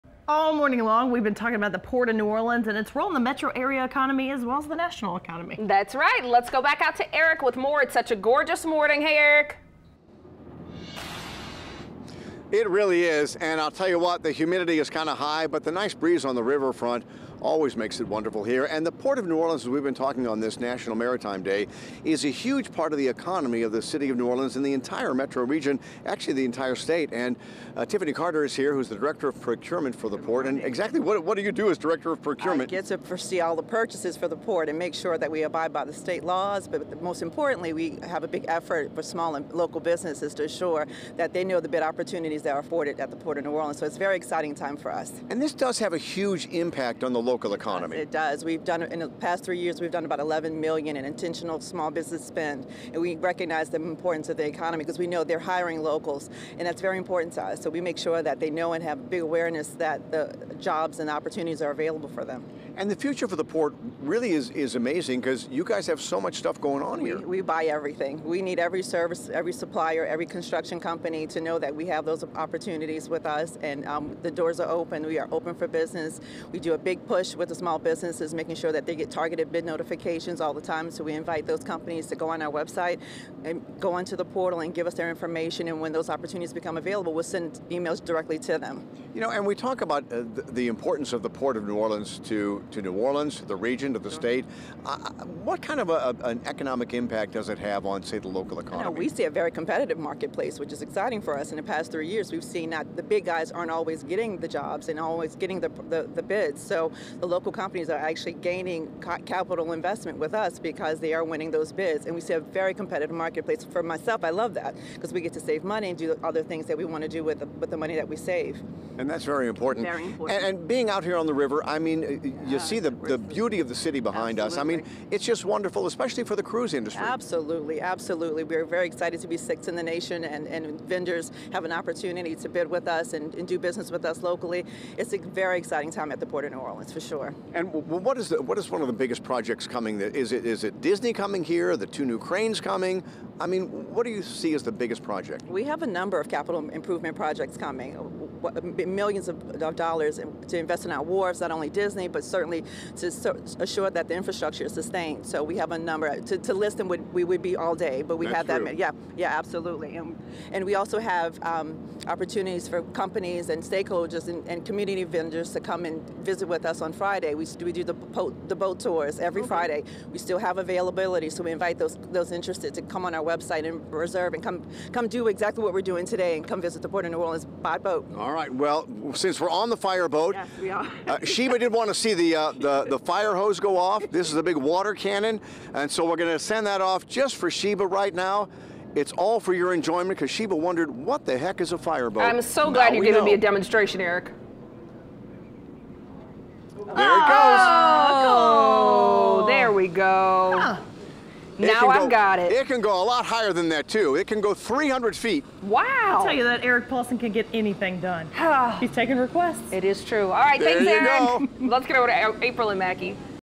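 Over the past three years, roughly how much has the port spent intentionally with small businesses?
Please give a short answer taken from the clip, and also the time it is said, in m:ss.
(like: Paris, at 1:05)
$11 million, at 0:50.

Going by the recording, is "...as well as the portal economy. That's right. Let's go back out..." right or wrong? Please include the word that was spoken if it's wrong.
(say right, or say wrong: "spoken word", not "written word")
wrong: "national", not "portal".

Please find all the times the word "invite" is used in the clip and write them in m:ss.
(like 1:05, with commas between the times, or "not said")
1:21, 2:51.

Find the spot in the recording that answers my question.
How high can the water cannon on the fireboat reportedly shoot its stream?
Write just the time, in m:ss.
3:24.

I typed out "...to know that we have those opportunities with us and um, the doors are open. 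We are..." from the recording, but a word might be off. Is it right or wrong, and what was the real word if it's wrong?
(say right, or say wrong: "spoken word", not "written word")
right.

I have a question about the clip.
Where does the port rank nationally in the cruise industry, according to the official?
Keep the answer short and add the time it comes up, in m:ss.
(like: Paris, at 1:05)
Sixth, at 2:09.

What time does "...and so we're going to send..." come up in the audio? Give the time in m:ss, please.
3:05.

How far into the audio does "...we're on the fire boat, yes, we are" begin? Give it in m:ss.
2:59.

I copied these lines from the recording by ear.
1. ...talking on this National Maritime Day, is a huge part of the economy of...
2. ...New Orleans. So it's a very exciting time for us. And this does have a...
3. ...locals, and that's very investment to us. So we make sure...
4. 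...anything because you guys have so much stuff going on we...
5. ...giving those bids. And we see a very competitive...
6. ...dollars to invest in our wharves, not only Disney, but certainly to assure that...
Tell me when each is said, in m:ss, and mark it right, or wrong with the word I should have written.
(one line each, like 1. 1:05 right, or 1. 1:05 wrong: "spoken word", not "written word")
1. 0:19 right
2. 0:43 right
3. 0:55 wrong: "important", not "investment"
4. 1:04 wrong: "amazing", not "anything"
5. 1:51 wrong: "winning", not "giving"
6. 2:29 right.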